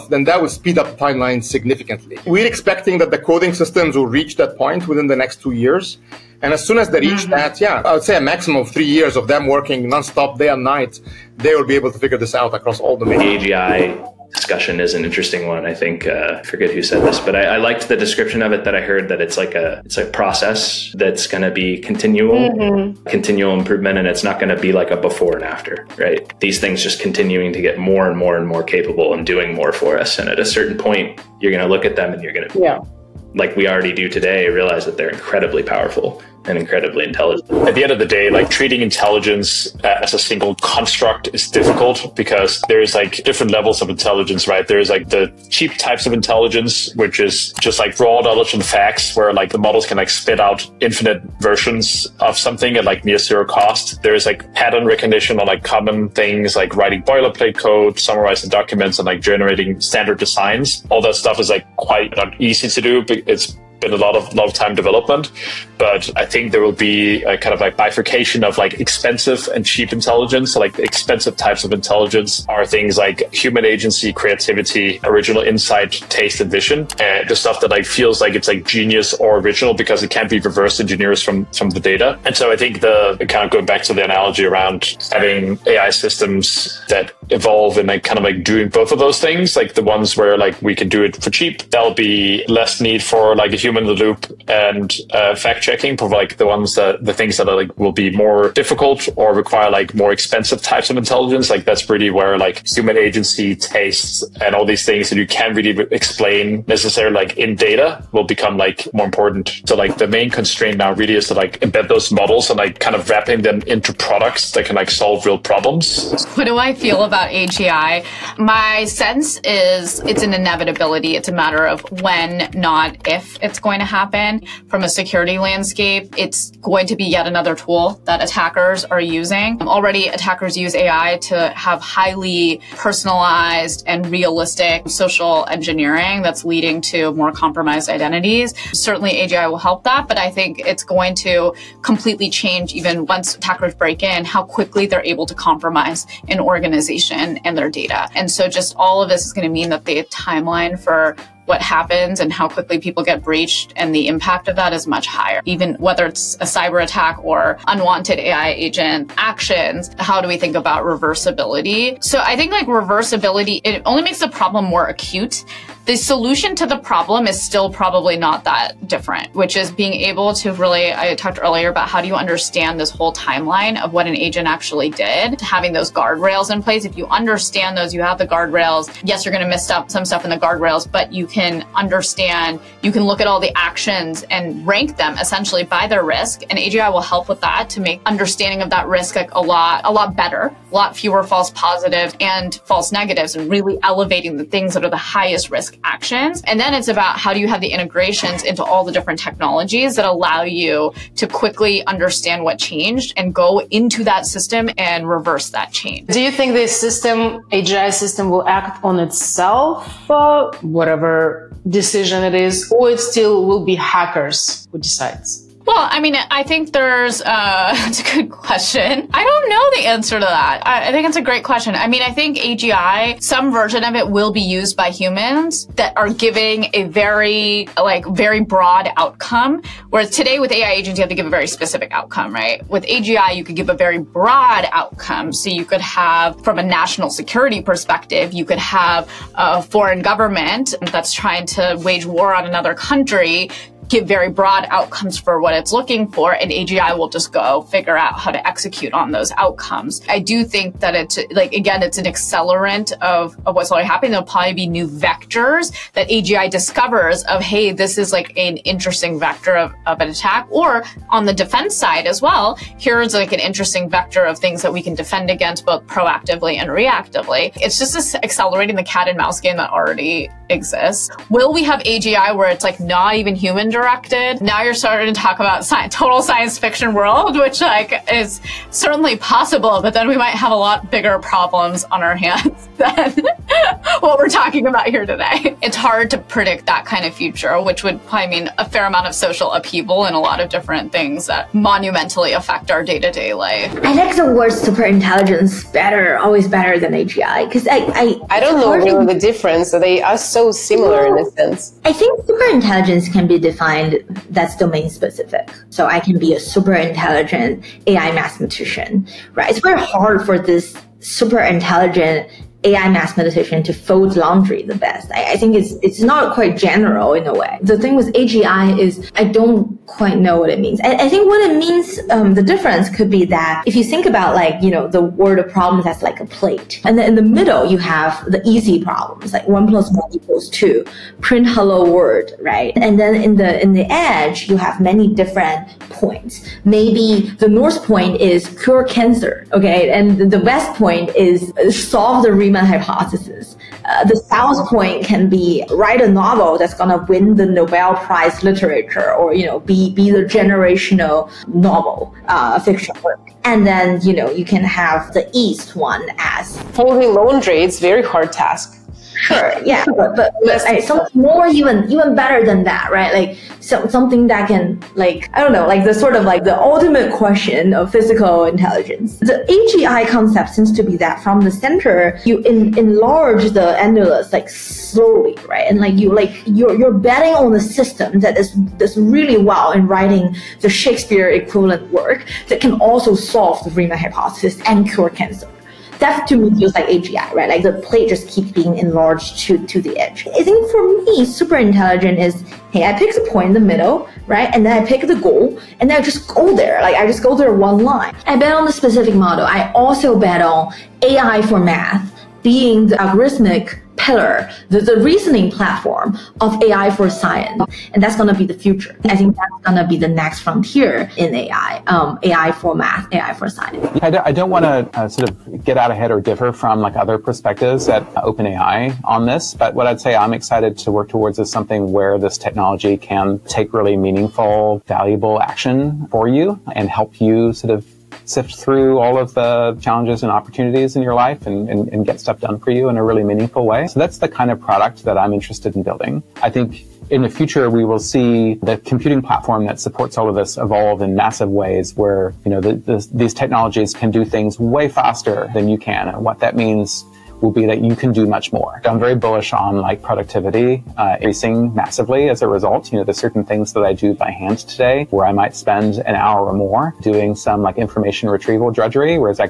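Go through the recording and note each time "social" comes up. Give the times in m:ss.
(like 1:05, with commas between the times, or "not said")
2:14, 4:49.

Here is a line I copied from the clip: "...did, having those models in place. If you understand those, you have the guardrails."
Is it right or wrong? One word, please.
wrong.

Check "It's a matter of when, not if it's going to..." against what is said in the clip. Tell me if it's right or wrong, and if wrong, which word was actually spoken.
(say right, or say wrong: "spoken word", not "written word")
right.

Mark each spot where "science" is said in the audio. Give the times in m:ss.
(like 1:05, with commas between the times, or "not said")
4:36, 6:47, 6:53.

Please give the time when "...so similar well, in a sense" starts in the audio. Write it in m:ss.
5:00.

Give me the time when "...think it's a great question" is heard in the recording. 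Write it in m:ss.
3:40.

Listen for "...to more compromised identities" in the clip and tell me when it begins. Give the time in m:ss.
2:16.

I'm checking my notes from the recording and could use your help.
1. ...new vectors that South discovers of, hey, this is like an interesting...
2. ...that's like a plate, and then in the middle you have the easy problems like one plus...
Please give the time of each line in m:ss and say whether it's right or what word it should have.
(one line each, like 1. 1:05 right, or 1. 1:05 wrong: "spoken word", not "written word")
1. 4:14 wrong: "AGI", not "South"
2. 5:25 right.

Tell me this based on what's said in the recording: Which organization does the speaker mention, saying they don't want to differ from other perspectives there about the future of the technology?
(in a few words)
OpenAI.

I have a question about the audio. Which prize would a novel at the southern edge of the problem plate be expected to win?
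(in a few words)
Nobel Prize literature.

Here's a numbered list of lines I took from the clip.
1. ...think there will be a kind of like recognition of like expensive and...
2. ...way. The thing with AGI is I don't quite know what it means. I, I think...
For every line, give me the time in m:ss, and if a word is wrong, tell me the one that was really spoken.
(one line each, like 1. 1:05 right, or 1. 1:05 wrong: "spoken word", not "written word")
1. 1:06 wrong: "bifurcation", not "recognition"
2. 5:17 right.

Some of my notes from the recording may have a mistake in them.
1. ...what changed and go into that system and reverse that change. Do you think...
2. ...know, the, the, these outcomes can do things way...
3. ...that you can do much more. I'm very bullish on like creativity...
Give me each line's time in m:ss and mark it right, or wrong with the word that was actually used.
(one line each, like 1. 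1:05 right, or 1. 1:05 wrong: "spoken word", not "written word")
1. 3:22 right
2. 7:22 wrong: "technologies", not "outcomes"
3. 7:27 wrong: "productivity", not "creativity".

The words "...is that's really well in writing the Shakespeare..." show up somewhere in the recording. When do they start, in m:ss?
6:18.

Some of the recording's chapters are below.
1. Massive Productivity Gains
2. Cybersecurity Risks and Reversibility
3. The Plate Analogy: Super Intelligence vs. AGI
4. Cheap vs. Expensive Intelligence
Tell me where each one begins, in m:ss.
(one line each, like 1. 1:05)
1. 6:56
2. 1:55
3. 4:53
4. 0:38.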